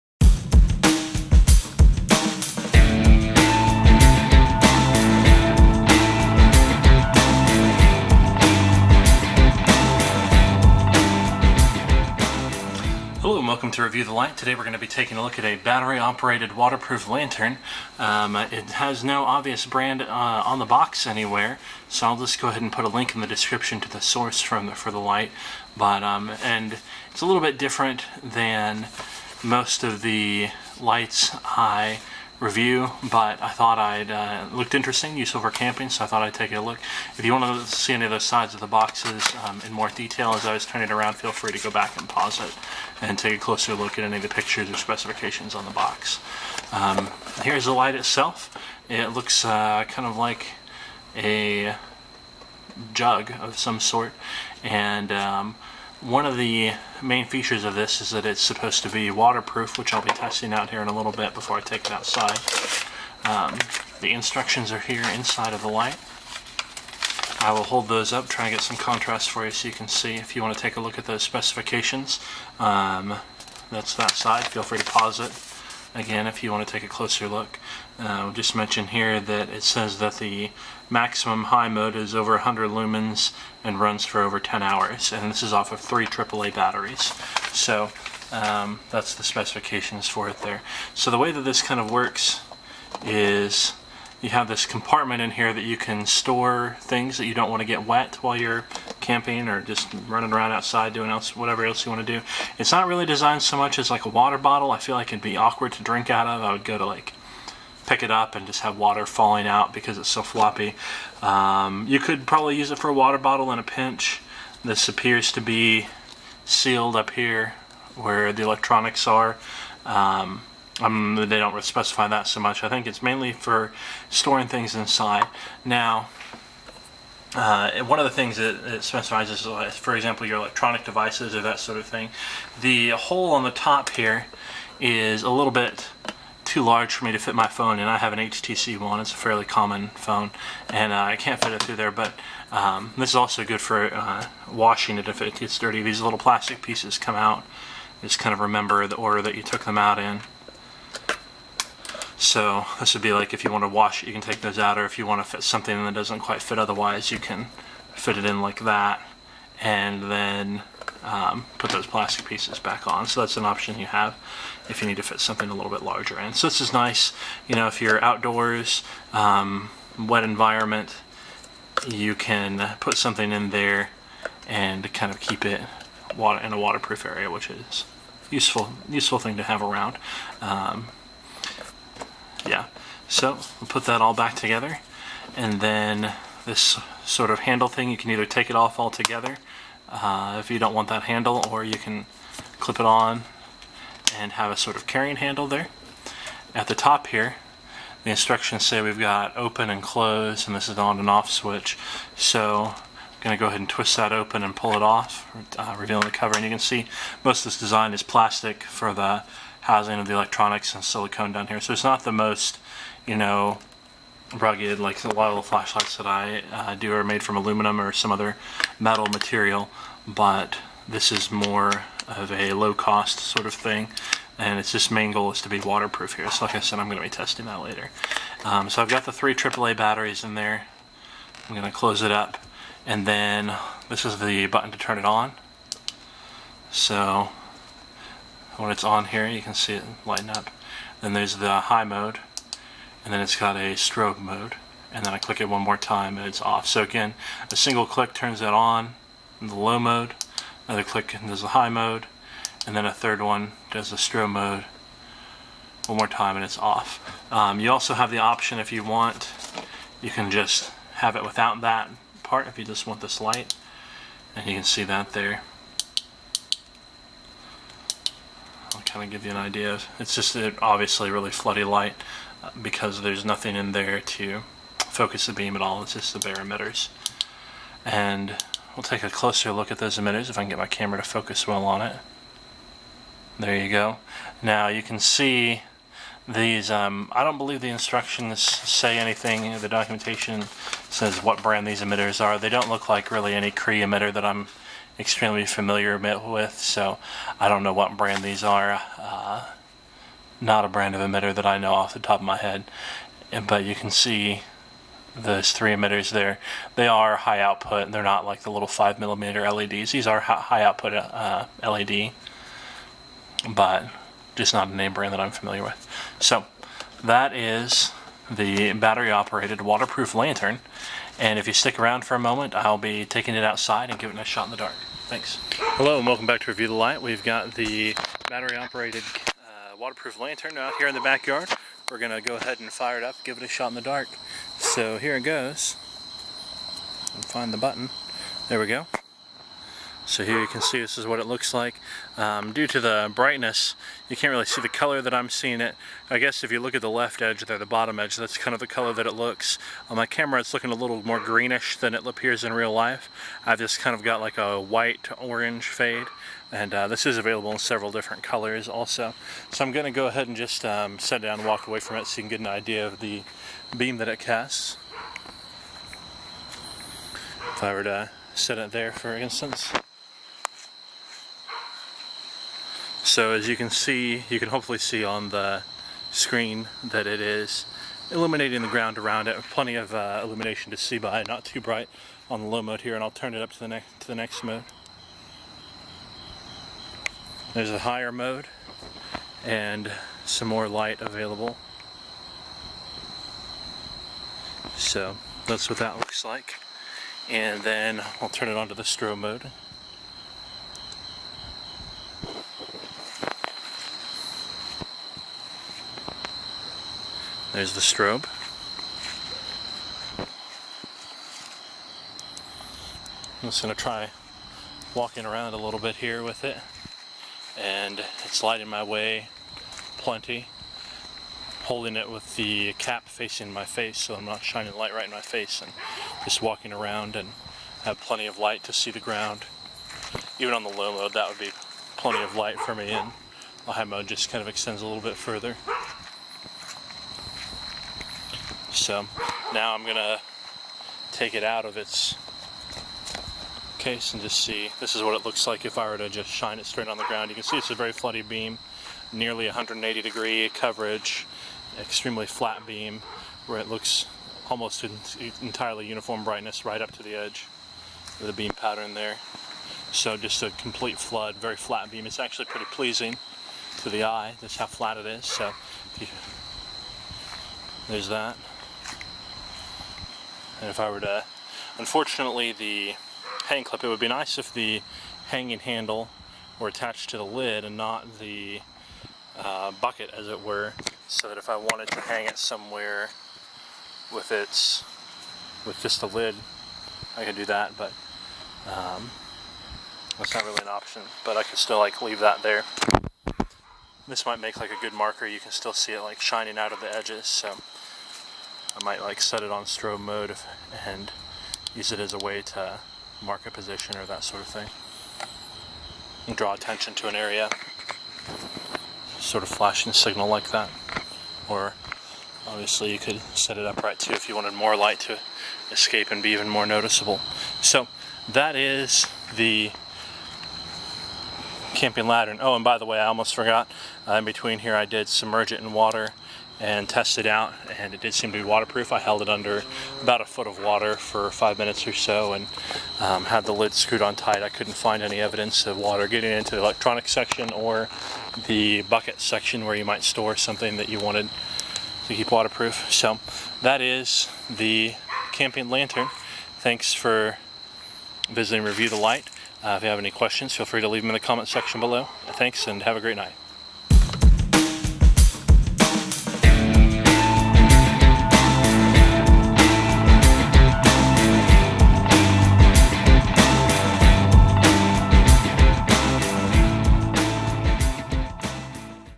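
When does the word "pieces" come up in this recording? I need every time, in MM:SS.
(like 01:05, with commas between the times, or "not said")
02:26, 02:42.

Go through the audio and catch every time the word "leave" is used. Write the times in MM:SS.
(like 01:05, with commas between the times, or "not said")
08:12, 09:10.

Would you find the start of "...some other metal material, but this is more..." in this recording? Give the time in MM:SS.
03:37.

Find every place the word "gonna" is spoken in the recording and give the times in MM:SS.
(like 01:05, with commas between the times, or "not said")
03:46, 03:51, 07:19.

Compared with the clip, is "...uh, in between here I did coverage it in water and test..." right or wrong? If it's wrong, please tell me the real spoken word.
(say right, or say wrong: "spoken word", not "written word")
wrong: "submerge", not "coverage".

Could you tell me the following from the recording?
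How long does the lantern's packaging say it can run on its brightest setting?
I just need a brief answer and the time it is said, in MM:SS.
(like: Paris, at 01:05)
over 10 hours, at 01:24.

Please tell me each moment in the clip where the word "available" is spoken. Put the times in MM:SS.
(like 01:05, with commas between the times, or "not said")
05:57, 06:31.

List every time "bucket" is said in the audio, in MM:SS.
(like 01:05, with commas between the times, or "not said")
07:59, 08:58.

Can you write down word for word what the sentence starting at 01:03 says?
Um, the instructions are here inside of the light.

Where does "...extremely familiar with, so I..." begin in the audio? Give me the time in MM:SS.
04:54.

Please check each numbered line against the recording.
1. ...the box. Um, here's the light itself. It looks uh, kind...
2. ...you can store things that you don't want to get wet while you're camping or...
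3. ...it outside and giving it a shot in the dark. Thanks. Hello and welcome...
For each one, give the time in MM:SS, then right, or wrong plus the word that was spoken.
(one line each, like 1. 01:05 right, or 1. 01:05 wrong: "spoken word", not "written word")
1. 00:45 right
2. 01:35 right
3. 05:23 right.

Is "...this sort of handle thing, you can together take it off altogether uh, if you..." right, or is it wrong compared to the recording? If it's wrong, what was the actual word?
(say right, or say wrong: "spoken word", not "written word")
wrong: "either", not "together".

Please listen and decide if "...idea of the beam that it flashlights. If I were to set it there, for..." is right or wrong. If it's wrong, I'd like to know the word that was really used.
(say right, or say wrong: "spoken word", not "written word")
wrong: "casts", not "flashlights".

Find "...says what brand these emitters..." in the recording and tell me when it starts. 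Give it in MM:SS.
04:50.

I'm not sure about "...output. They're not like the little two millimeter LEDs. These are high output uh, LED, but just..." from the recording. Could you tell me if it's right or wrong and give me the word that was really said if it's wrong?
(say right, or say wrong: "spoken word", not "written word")
wrong: "five", not "two".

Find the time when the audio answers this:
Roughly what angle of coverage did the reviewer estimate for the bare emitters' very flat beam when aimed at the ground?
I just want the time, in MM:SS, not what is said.
07:29.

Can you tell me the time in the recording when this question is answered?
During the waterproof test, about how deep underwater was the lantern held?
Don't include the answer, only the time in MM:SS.
08:50.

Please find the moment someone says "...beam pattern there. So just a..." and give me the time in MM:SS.
07:38.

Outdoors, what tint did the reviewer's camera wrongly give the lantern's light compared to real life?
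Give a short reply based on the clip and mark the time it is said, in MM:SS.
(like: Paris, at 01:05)
greenish, at 05:51.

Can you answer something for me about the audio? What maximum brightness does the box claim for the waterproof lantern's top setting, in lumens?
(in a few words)
over 100 lumens.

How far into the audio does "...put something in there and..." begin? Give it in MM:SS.
02:52.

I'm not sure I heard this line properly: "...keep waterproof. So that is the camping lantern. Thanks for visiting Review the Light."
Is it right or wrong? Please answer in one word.
right.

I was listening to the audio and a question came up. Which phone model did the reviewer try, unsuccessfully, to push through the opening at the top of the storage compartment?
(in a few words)
HTC One.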